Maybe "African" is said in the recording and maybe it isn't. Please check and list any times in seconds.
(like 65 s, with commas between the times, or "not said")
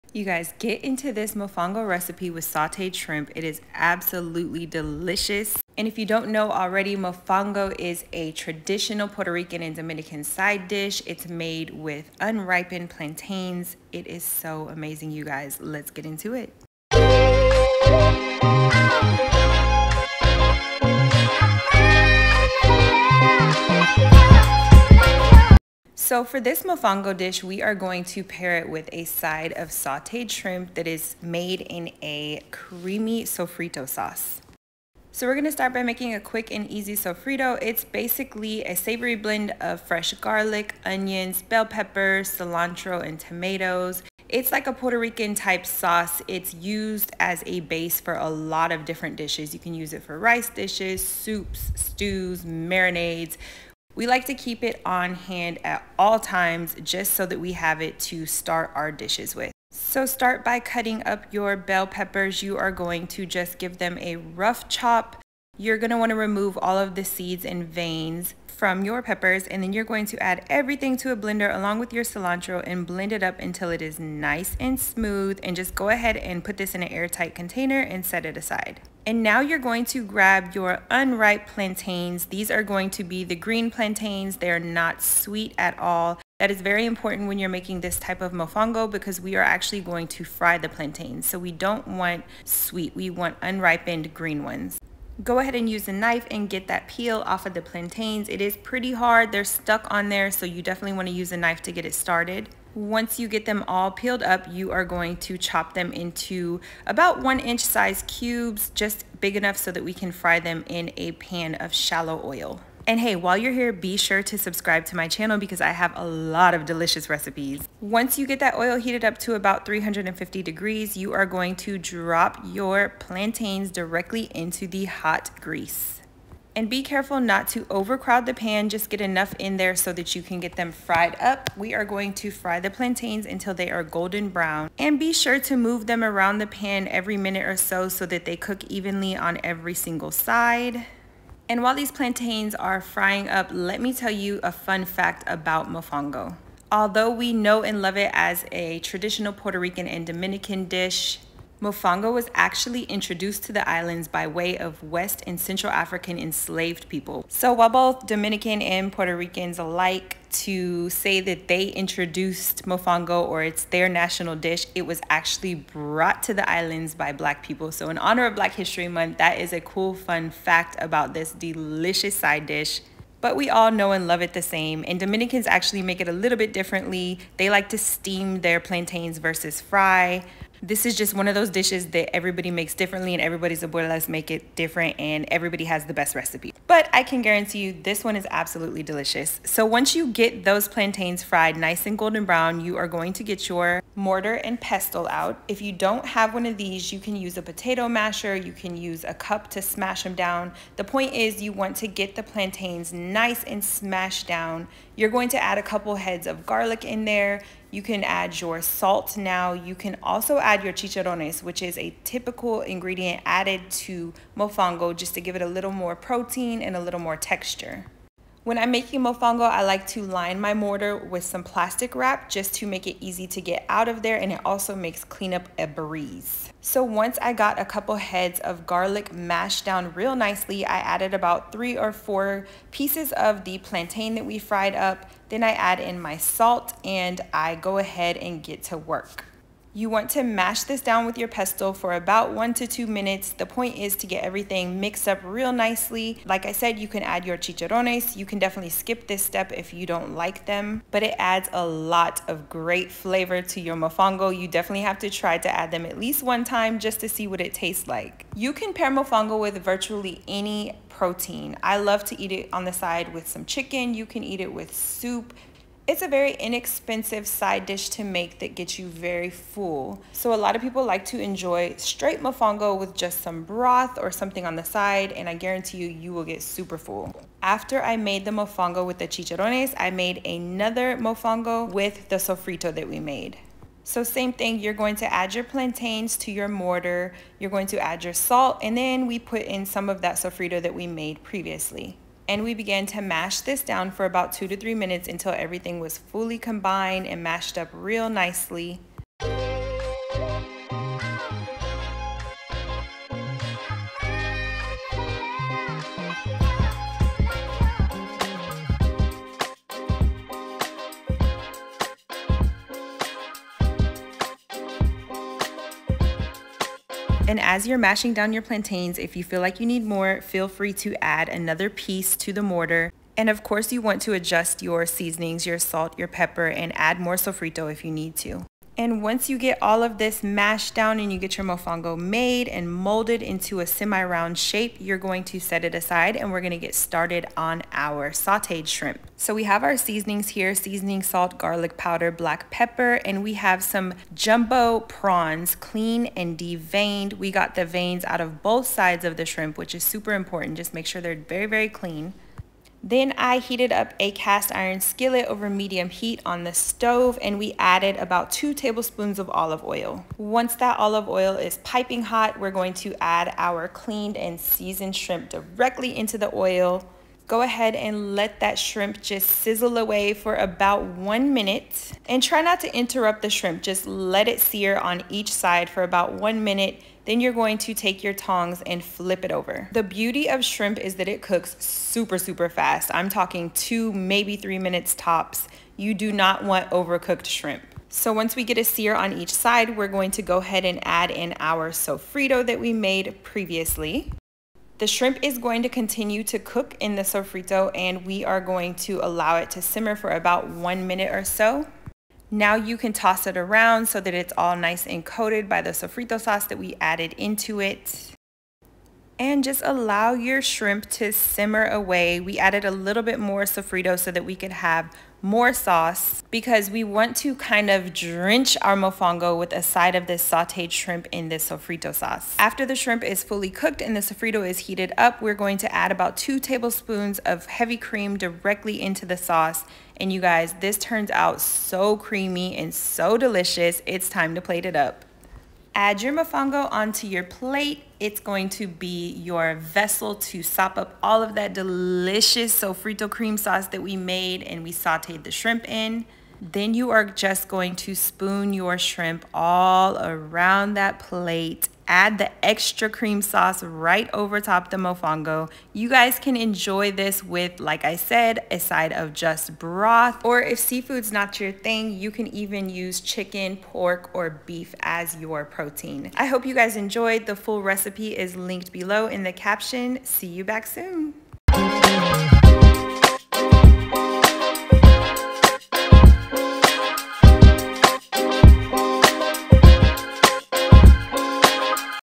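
155 s.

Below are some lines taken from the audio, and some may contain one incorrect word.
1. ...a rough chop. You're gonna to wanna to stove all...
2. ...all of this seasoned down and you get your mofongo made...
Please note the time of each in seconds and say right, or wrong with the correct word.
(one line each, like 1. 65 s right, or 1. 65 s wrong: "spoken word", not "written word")
1. 63 s wrong: "remove", not "stove"
2. 329 s wrong: "mashed", not "seasoned".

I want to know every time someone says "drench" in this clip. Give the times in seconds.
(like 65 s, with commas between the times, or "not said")
417 s.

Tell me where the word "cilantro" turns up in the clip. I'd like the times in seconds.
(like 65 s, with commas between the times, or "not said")
42 s, 72 s.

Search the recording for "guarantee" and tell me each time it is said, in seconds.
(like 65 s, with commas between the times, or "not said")
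187 s, 275 s.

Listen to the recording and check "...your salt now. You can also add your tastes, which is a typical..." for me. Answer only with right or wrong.
wrong.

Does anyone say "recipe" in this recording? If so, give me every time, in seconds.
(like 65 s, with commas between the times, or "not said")
1 s, 117 s, 186 s, 467 s.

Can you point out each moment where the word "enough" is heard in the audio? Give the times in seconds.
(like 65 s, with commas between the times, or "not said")
109 s, 128 s.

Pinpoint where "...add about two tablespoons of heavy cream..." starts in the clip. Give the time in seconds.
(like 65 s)
425 s.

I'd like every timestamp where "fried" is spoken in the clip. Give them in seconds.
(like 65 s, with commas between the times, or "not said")
130 s, 191 s, 234 s.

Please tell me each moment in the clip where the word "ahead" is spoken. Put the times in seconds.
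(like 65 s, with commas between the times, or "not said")
75 s, 95 s, 237 s, 367 s, 390 s.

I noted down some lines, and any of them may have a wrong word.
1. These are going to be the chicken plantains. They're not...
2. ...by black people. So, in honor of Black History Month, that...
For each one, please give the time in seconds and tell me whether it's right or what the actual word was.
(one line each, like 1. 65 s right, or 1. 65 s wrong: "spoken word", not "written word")
1. 82 s wrong: "green", not "chicken"
2. 166 s right.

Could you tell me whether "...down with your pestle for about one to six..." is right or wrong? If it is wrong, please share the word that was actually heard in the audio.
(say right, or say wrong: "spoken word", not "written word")
wrong: "two", not "six".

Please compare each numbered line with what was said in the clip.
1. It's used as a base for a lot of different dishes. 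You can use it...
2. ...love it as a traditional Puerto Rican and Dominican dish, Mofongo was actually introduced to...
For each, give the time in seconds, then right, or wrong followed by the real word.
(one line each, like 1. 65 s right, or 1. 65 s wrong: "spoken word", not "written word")
1. 46 s right
2. 147 s right.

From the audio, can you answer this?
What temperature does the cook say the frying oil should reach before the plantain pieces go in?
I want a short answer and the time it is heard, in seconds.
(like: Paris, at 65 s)
350 degrees, at 119 s.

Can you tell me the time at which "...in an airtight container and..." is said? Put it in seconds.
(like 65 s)
76 s.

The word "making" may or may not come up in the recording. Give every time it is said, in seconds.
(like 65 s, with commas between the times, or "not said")
35 s, 87 s, 218 s.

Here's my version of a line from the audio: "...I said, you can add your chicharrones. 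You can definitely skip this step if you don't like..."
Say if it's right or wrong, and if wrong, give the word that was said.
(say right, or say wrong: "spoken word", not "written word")
right.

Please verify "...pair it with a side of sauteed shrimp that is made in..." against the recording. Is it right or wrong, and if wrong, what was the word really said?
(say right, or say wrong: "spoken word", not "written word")
right.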